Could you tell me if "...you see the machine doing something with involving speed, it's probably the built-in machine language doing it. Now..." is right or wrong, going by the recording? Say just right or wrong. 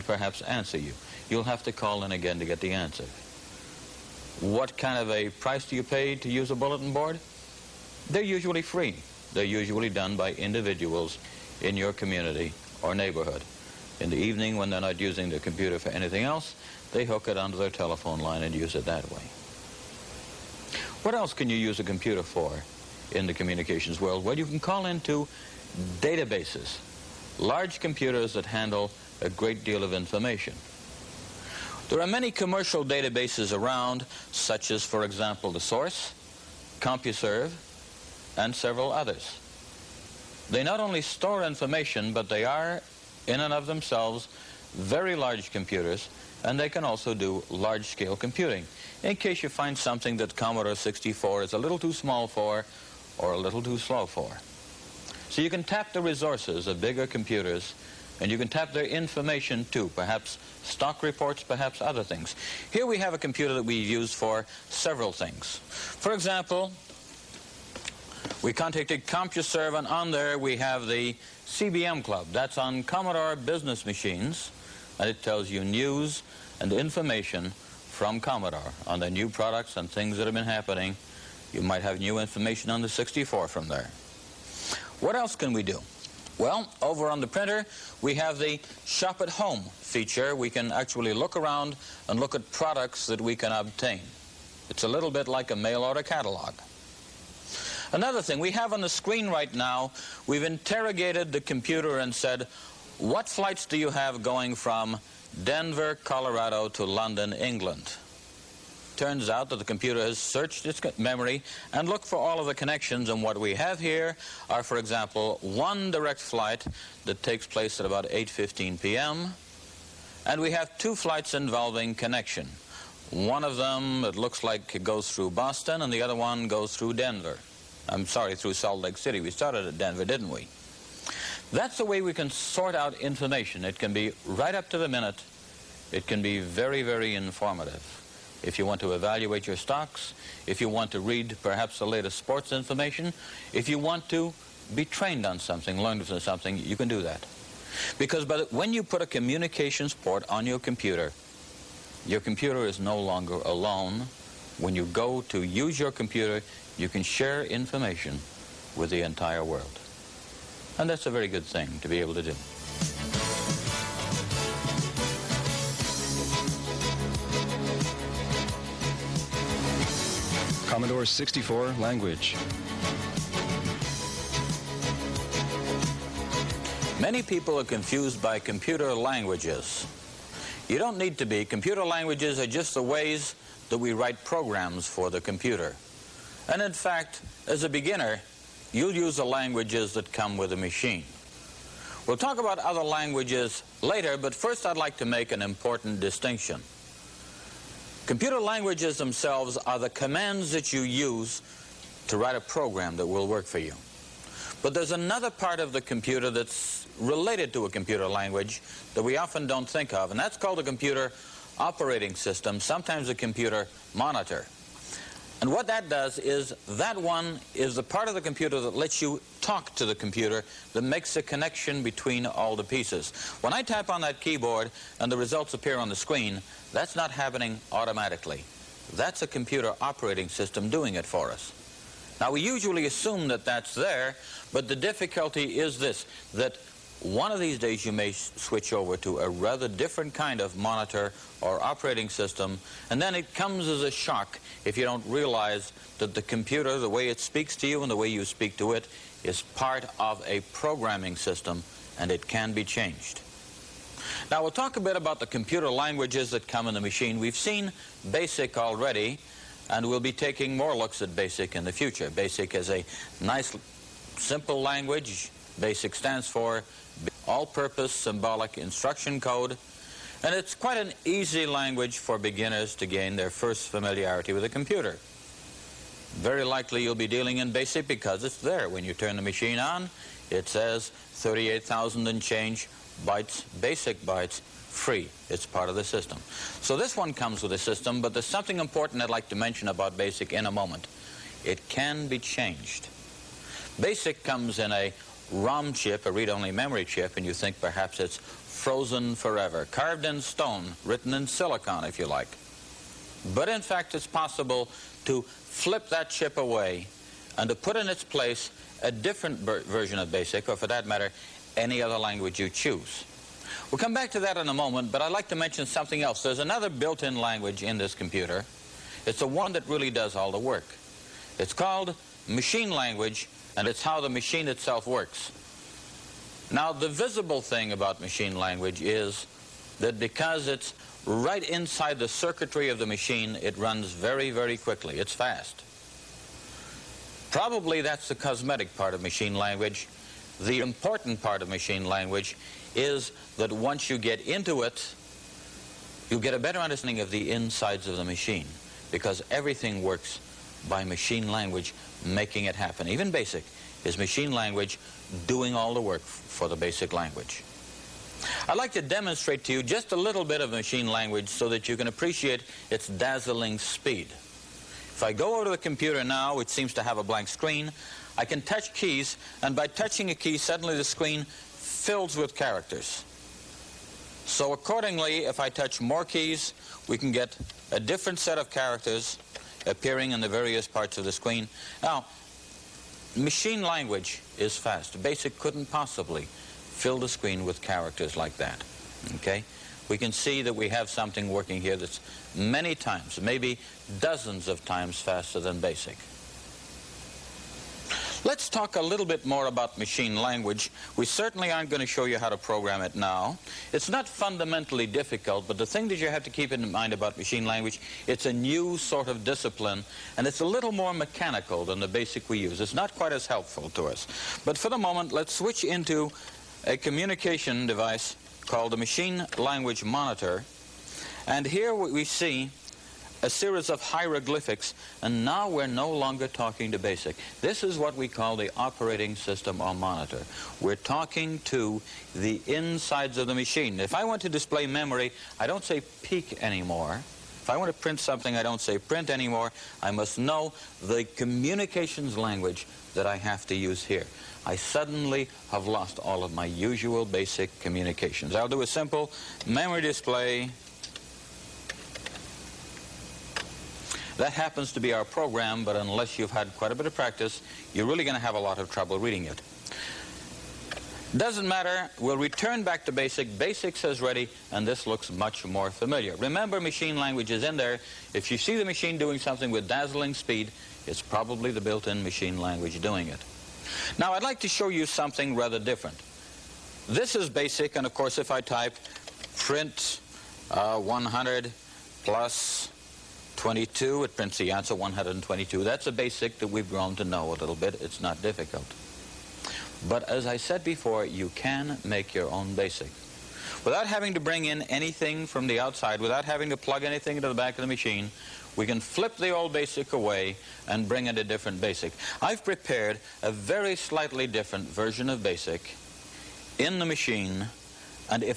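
wrong.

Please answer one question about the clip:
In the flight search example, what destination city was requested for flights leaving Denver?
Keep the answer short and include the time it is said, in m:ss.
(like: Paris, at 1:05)
London, at 1:46.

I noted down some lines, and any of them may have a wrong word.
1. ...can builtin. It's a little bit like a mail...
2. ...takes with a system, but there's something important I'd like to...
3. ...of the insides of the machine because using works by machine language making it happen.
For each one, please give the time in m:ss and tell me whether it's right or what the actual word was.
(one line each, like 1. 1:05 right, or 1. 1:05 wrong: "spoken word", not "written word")
1. 1:33 wrong: "obtain", not "builtin"
2. 4:47 wrong: "comes", not "takes"
3. 5:47 wrong: "everything", not "using".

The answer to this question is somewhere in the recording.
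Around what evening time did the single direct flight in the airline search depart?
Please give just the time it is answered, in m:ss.
1:58.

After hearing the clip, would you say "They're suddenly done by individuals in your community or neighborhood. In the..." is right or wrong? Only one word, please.
wrong.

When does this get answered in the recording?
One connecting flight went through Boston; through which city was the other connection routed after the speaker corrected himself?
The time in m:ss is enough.
2:08.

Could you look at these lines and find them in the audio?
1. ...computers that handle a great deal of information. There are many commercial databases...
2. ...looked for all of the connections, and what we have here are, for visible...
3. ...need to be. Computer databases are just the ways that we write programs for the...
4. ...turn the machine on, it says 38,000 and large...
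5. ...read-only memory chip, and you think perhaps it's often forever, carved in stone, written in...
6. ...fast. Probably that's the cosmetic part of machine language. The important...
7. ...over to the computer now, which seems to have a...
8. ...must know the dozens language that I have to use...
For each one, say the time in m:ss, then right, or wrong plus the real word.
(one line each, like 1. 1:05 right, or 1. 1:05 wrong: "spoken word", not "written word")
1. 0:27 right
2. 1:51 wrong: "example", not "visible"
3. 3:00 wrong: "languages", not "databases"
4. 4:38 wrong: "change", not "large"
5. 4:56 wrong: "frozen", not "often"
6. 5:35 right
7. 6:05 right
8. 7:19 wrong: "communications", not "dozens".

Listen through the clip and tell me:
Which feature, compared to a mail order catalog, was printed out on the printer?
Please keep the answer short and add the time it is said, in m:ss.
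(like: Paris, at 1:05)
Shop at Home, at 1:28.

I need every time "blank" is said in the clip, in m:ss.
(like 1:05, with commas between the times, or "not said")
6:07.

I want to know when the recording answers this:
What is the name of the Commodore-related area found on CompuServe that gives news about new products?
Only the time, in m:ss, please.
1:11.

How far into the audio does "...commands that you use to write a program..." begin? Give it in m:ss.
3:19.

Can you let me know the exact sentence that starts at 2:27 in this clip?
Because the, when you put a communications port on your computer, your computer is no longer alone.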